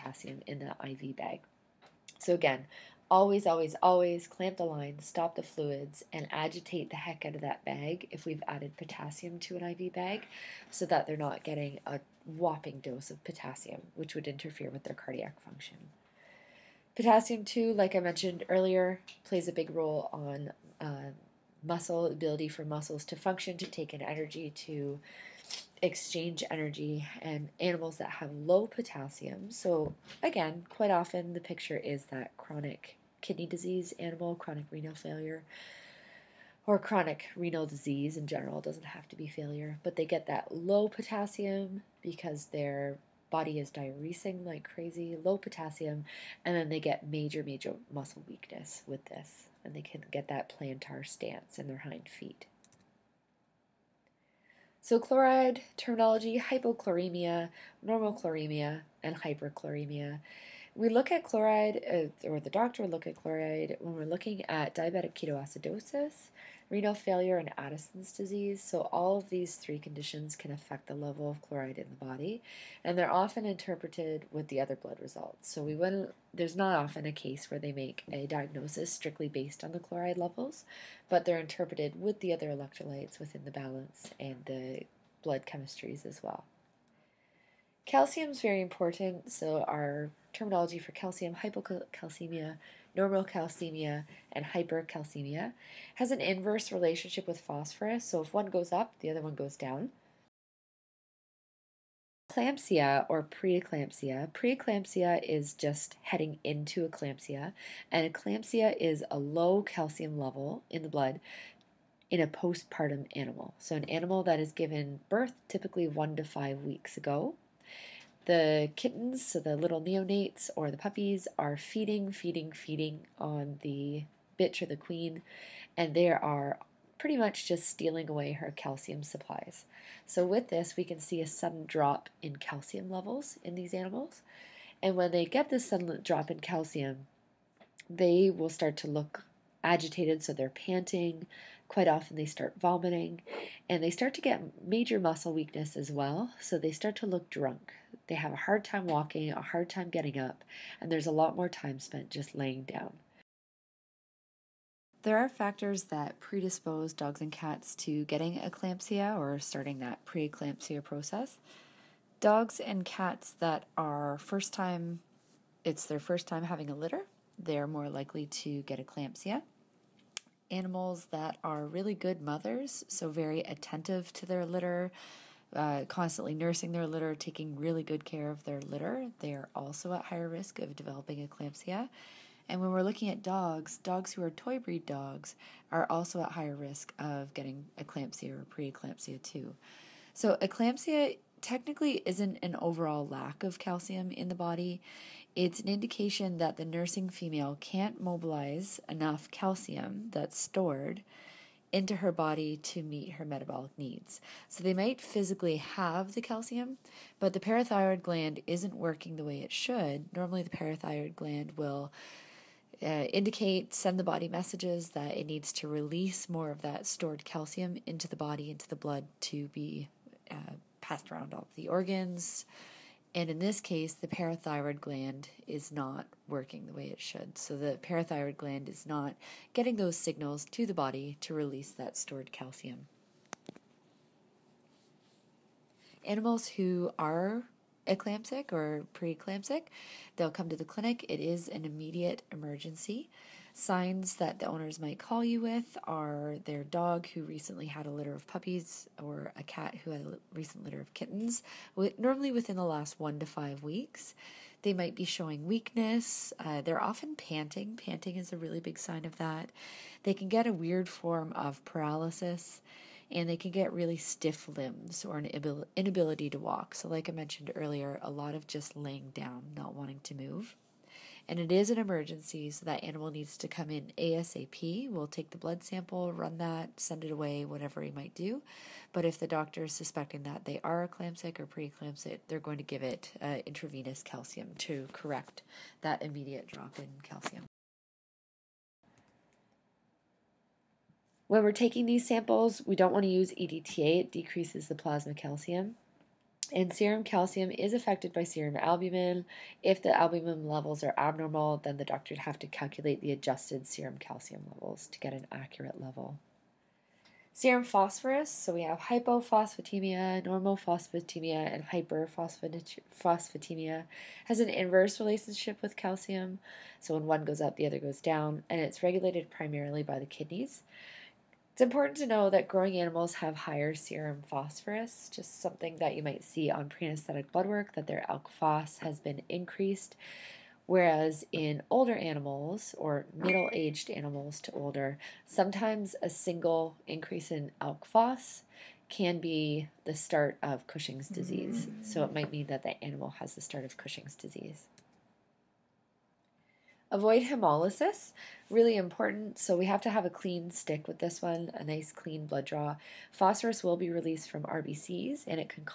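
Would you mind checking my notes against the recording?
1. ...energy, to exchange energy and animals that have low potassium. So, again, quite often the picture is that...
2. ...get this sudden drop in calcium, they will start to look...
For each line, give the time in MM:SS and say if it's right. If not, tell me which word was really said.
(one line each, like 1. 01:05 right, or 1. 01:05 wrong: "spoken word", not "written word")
1. 00:24 right
2. 02:15 right.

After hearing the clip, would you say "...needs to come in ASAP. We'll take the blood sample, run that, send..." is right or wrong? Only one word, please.
right.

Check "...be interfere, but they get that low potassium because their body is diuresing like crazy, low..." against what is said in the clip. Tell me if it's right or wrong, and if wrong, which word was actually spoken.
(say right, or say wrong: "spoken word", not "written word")
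wrong: "failure", not "interfere".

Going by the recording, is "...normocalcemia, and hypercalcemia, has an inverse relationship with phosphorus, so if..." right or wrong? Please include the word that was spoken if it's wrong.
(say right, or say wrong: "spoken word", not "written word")
right.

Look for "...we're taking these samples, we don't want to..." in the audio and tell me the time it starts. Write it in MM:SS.
04:51.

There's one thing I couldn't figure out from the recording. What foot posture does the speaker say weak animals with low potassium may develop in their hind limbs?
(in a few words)
plantar stance.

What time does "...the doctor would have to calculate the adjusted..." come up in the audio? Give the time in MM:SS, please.
05:01.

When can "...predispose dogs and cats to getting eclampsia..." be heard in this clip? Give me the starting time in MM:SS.
02:36.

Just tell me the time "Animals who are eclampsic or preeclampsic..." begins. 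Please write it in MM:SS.
03:56.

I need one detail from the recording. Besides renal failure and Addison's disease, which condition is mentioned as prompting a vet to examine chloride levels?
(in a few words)
diabetic ketoacidosis.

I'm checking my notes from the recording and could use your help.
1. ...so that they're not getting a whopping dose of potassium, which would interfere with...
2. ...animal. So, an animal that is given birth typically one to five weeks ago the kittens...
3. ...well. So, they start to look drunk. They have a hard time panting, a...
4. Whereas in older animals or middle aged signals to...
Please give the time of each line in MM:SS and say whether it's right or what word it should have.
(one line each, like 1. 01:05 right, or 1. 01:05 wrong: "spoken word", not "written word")
1. 00:10 right
2. 01:53 right
3. 02:25 wrong: "walking", not "panting"
4. 05:30 wrong: "animals", not "signals".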